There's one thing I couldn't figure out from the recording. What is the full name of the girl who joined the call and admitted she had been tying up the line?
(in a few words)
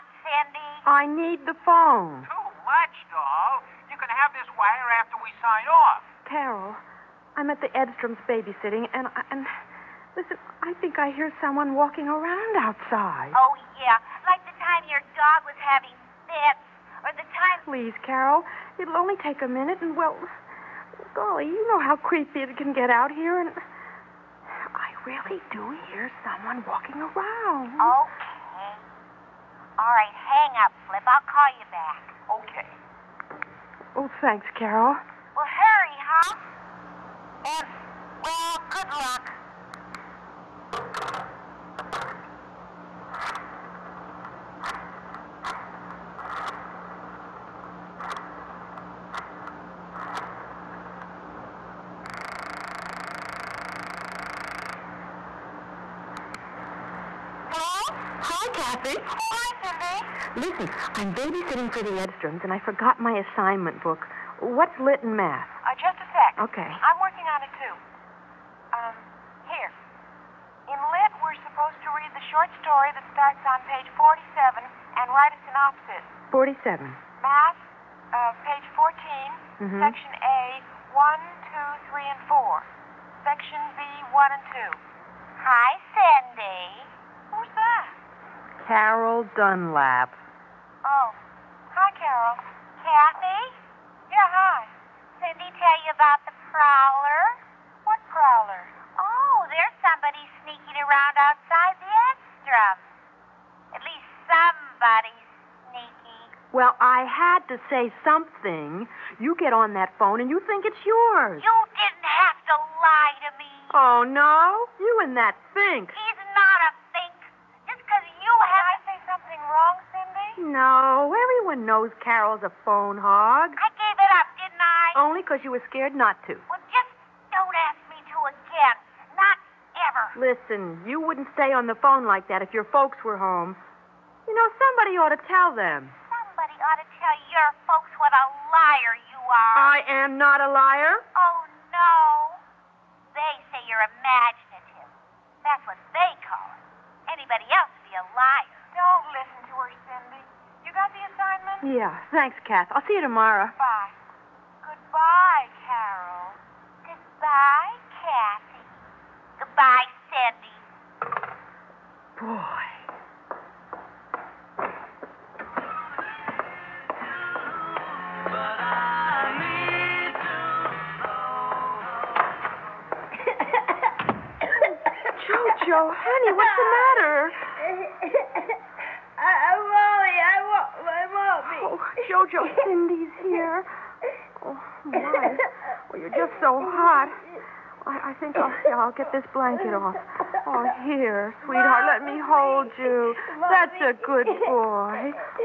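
Carol Dunlap.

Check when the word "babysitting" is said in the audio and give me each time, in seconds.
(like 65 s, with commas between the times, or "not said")
8 s, 61 s.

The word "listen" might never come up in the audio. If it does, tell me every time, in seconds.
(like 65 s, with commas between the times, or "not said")
10 s, 60 s, 130 s.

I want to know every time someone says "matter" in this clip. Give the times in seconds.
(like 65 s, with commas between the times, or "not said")
177 s.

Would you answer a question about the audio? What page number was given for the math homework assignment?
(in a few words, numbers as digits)
14.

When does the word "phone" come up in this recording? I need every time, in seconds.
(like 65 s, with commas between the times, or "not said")
1 s, 109 s, 122 s, 131 s.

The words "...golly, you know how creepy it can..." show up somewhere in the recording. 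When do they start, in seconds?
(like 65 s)
21 s.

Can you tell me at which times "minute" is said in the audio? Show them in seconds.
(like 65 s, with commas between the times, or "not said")
19 s.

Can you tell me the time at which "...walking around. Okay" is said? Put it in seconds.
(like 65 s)
26 s.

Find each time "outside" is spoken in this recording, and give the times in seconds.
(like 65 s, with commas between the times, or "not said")
12 s, 101 s.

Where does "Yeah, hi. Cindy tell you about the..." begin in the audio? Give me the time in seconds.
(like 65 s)
94 s.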